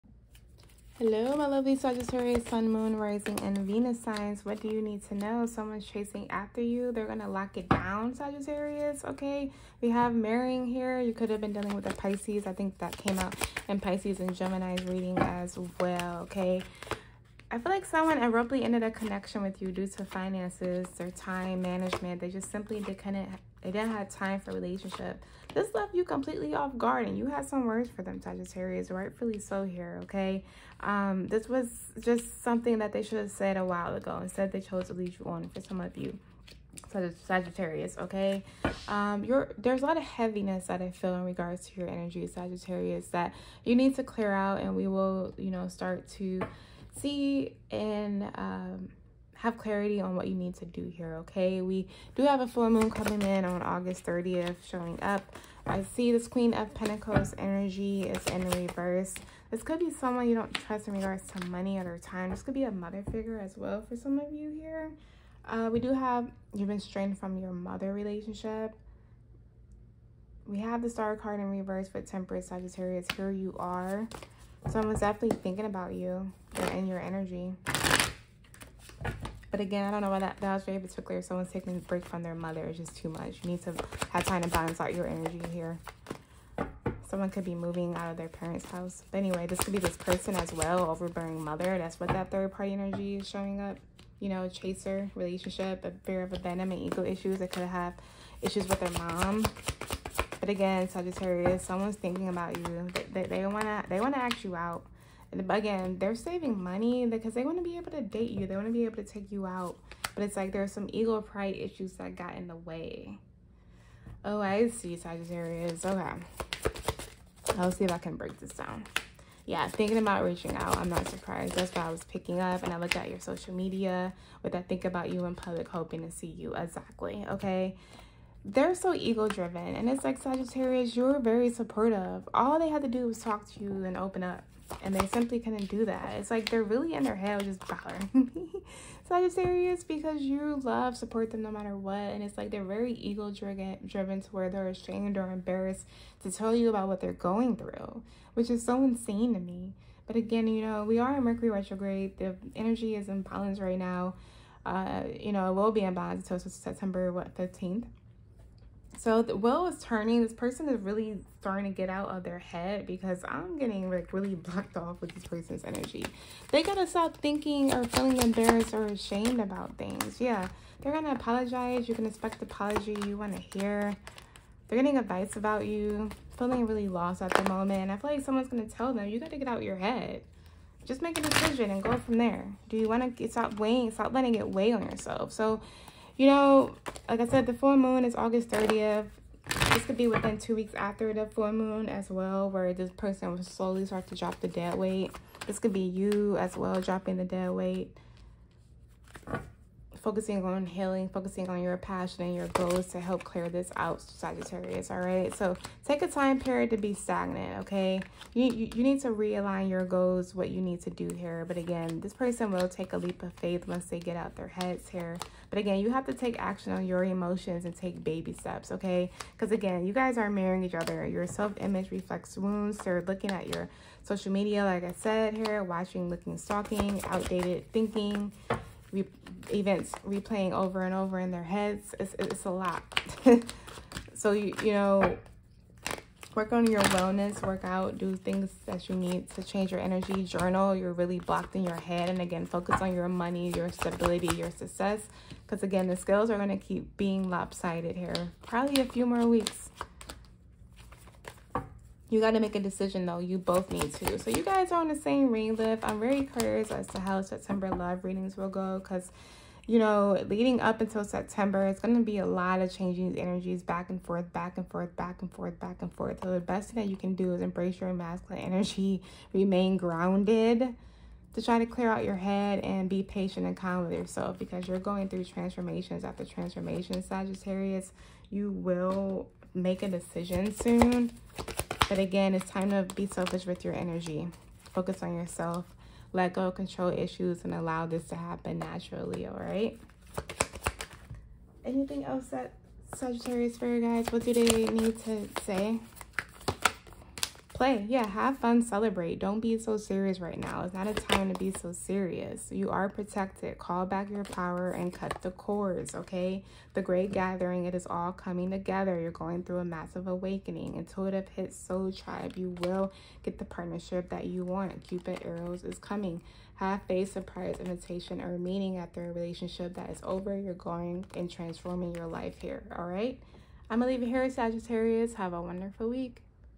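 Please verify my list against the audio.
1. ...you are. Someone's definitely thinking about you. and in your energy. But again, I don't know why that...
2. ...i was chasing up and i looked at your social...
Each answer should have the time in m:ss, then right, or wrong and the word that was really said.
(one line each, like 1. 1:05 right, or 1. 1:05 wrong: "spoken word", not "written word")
1. 1:13 right
2. 2:01 wrong: "picking", not "chasing".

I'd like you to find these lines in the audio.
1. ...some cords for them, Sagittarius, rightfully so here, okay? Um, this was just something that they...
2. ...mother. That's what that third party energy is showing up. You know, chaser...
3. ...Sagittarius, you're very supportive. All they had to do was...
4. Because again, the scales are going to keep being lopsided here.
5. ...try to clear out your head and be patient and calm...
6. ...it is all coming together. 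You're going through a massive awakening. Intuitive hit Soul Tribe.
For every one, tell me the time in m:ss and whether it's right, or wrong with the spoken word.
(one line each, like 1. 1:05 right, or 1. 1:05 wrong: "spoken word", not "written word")
1. 0:27 wrong: "words", not "cords"
2. 1:31 right
3. 2:10 right
4. 4:05 right
5. 4:31 right
6. 5:07 right.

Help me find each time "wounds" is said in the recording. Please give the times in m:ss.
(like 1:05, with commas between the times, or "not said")
3:42.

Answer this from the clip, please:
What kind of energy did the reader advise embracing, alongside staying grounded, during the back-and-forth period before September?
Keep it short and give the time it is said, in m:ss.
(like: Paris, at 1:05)
masculine energy, at 4:27.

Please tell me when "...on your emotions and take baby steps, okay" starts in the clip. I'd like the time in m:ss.
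3:36.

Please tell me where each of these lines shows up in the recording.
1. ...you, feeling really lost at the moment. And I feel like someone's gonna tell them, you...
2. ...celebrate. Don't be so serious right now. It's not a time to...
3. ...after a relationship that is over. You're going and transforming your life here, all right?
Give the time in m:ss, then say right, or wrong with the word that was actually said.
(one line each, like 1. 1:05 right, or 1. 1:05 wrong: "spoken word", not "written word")
1. 2:55 right
2. 4:58 right
3. 5:18 right.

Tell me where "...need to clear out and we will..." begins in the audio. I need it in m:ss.
0:43.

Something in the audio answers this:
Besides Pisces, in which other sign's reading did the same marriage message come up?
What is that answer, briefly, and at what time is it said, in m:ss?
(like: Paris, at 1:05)
Gemini, at 0:14.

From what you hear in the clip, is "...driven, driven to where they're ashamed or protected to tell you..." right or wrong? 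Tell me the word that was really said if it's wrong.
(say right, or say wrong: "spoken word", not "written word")
wrong: "embarrassed", not "protected".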